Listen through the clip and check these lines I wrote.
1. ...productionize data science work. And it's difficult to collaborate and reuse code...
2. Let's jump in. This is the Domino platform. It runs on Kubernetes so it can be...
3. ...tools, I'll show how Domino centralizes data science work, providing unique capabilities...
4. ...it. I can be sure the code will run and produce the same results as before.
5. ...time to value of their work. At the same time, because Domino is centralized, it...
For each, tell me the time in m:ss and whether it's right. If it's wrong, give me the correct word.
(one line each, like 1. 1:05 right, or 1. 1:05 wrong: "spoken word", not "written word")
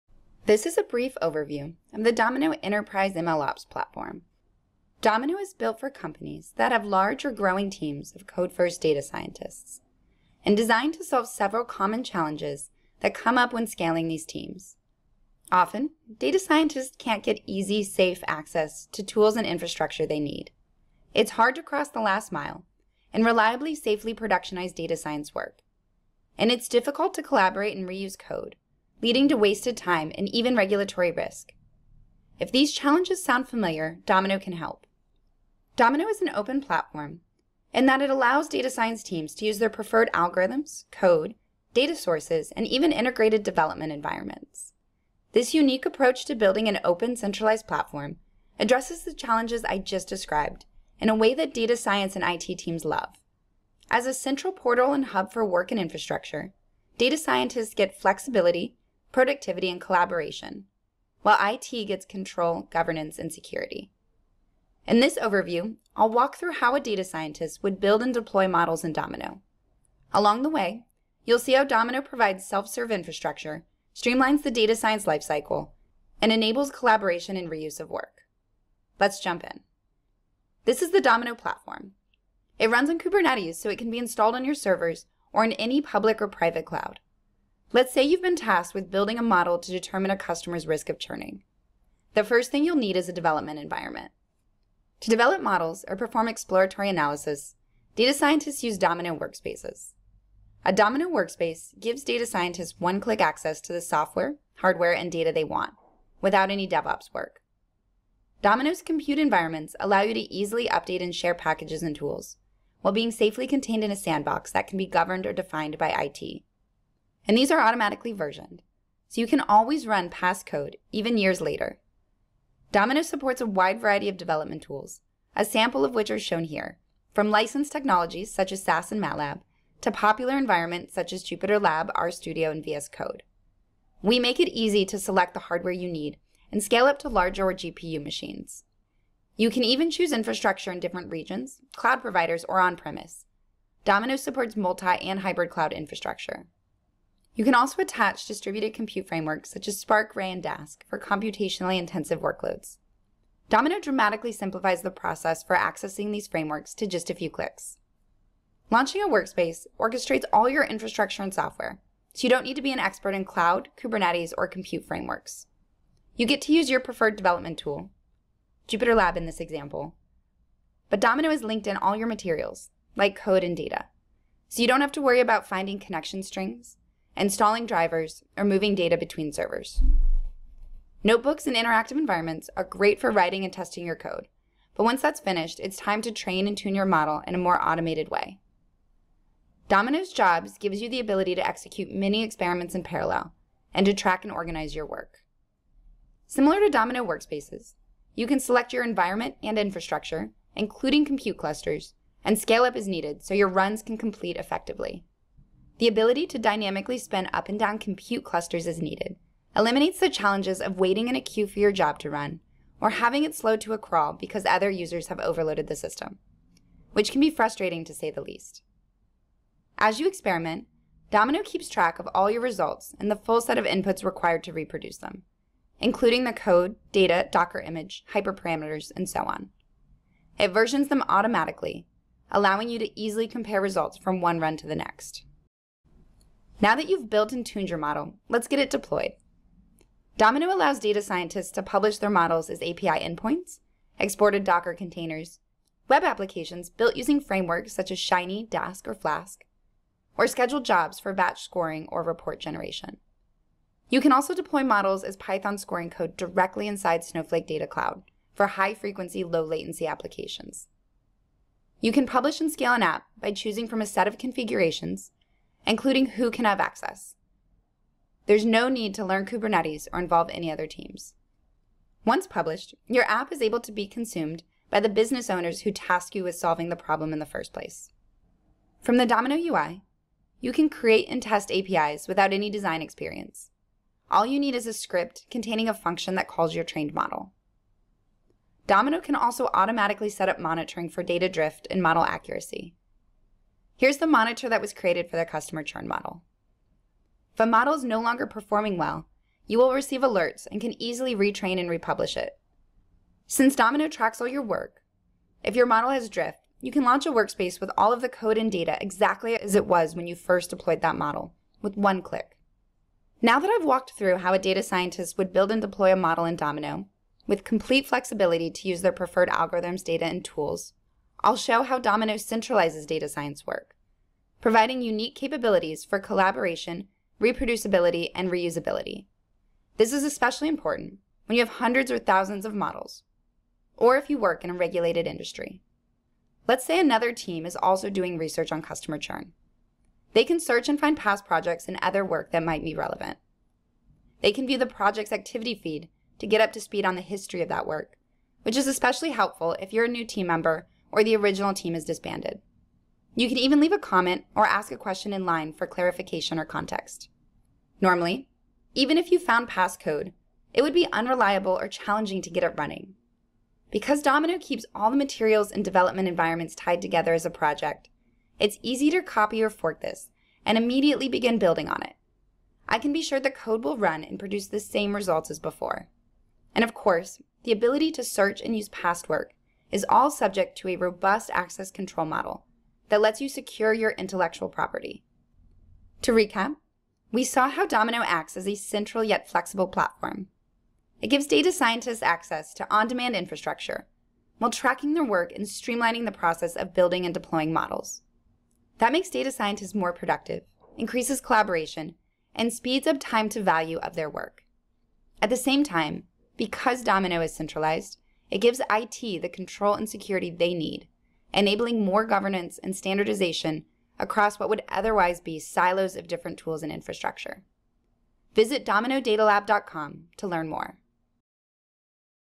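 1. 0:24 right
2. 1:18 right
3. 5:20 right
4. 6:11 right
5. 6:42 right.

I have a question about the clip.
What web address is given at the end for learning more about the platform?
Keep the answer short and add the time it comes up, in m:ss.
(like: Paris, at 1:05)
dominodatalab.com, at 6:58.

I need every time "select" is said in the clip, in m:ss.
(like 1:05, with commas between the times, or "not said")
2:14, 3:18.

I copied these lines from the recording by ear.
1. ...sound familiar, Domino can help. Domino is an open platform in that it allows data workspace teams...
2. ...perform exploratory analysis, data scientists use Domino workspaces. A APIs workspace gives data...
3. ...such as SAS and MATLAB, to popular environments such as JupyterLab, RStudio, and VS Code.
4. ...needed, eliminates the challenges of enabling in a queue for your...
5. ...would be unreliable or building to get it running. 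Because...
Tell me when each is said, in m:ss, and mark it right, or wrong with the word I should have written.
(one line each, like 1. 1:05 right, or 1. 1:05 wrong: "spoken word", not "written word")
1. 0:33 wrong: "science", not "workspace"
2. 1:35 wrong: "Domino", not "APIs"
3. 2:08 right
4. 3:28 wrong: "waiting", not "enabling"
5. 6:00 wrong: "challenging", not "building".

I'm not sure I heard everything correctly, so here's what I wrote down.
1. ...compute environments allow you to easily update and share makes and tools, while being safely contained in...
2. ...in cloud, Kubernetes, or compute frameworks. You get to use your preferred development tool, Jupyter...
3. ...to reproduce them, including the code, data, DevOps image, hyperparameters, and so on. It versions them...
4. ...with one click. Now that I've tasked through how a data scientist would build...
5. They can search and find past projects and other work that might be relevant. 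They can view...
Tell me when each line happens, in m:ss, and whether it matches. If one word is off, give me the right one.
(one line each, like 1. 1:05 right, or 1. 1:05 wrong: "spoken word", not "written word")
1. 1:48 wrong: "packages", not "makes"
2. 2:43 right
3. 3:44 wrong: "Docker", not "DevOps"
4. 5:11 wrong: "walked", not "tasked"
5. 5:40 right.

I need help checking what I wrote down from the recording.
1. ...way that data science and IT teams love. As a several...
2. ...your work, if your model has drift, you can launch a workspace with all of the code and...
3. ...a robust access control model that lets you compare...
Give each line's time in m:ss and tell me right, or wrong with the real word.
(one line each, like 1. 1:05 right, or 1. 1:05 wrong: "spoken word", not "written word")
1. 0:51 wrong: "central", not "several"
2. 5:04 right
3. 6:20 wrong: "secure", not "compare".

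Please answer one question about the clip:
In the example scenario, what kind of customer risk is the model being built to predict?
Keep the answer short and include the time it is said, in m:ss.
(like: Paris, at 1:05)
Churning, at 1:30.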